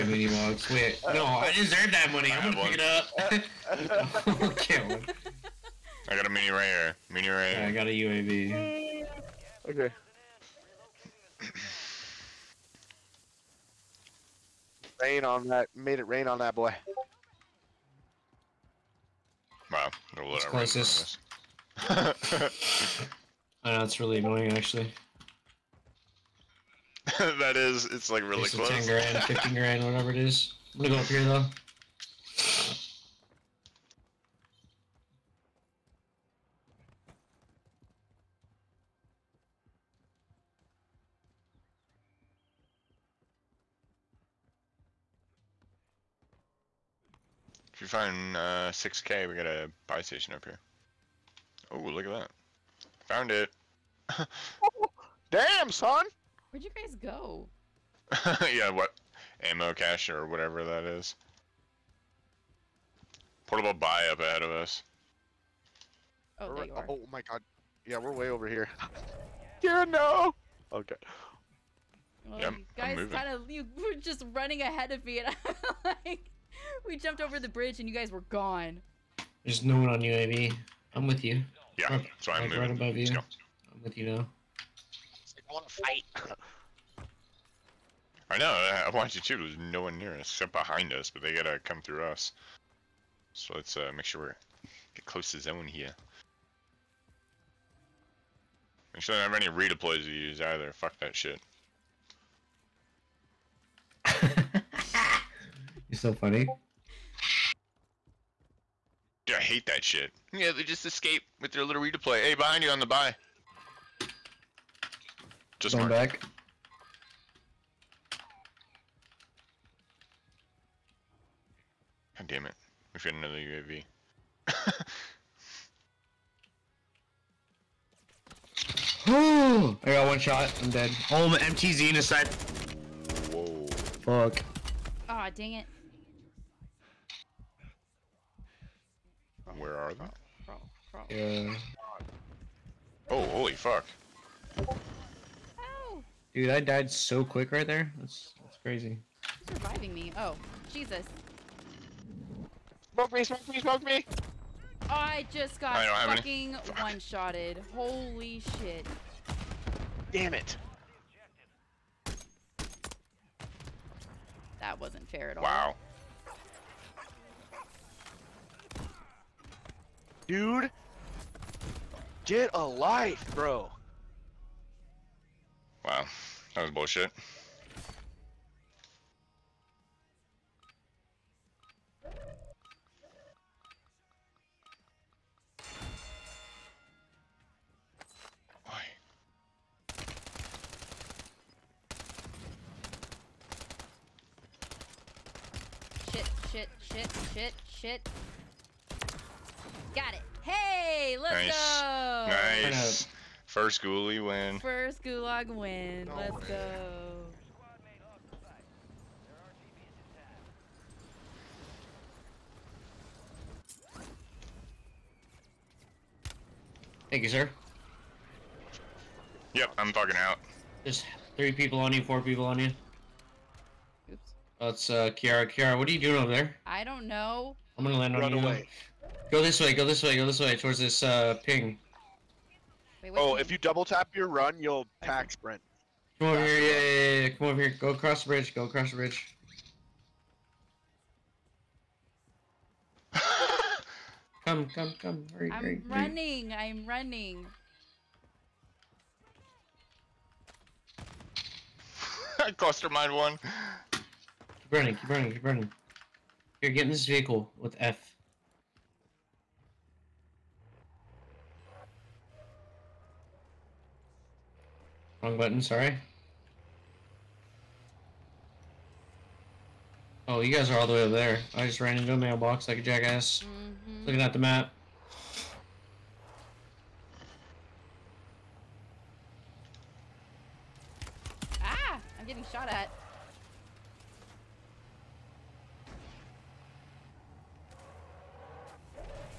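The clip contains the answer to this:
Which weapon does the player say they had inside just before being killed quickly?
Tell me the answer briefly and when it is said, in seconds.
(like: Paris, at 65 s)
MTZ, at 131 s.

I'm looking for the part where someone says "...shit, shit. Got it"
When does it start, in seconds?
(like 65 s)
197 s.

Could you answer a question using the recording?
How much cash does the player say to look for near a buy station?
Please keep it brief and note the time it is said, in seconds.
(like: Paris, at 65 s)
6k, at 48 s.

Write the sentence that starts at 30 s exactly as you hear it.
I'm gonna go up here though.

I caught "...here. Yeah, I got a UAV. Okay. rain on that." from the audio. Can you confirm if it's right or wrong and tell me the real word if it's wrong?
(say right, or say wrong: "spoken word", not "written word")
right.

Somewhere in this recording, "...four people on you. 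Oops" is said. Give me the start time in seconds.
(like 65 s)
222 s.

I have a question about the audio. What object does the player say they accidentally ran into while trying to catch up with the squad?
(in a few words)
a mailbox.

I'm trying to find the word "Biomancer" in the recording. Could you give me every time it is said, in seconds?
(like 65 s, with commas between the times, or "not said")
not said.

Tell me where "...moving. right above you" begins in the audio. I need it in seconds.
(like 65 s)
82 s.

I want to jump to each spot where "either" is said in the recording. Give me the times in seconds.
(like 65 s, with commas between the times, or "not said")
100 s.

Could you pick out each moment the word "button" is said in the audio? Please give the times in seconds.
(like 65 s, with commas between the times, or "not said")
265 s.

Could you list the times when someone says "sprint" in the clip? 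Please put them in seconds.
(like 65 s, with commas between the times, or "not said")
235 s.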